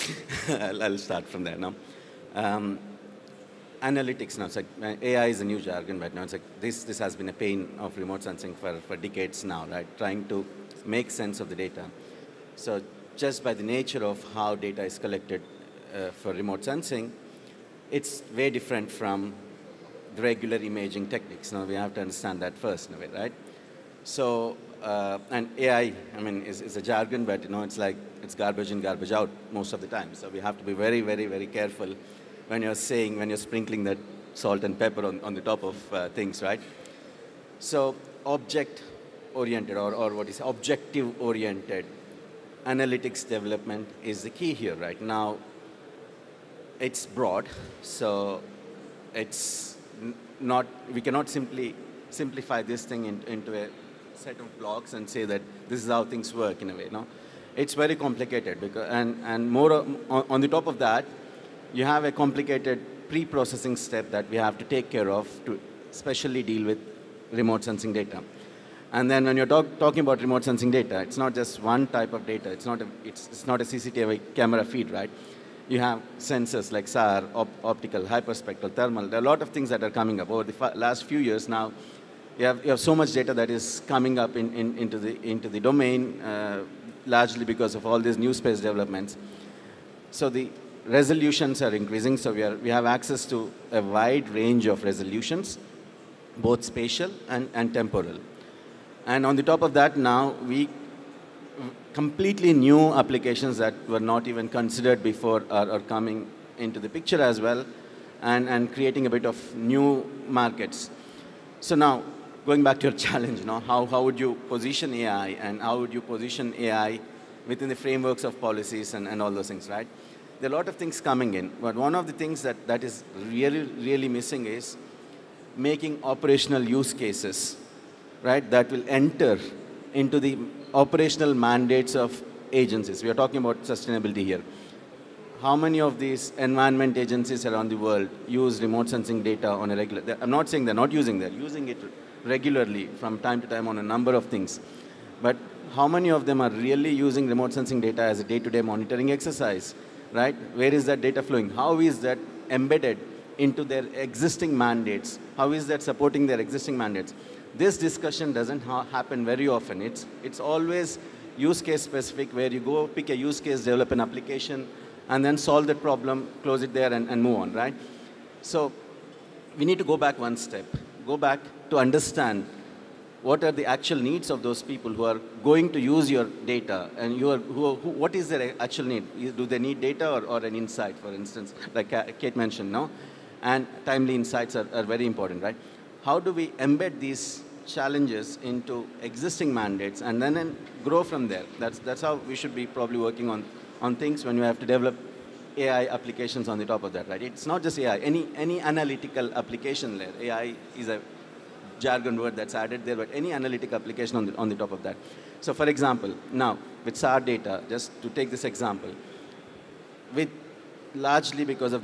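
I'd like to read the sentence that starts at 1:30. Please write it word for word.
So the resolutions are increasing, so we, are, we have access to a wide range of resolutions, both spatial and, and temporal.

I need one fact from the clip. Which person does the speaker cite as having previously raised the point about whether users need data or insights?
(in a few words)
Kate.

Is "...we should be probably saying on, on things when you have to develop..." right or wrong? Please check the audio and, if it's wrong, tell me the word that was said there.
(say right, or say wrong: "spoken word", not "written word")
wrong: "working", not "saying".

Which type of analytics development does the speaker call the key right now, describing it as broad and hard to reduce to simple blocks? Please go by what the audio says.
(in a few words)
Objective oriented analytics.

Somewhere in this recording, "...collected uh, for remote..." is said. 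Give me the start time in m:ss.
0:14.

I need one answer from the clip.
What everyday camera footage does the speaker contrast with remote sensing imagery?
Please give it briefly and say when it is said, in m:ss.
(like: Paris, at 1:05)
CCTV camera feed, at 1:13.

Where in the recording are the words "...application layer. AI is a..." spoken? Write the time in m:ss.
3:19.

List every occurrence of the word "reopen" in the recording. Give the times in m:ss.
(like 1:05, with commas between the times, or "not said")
not said.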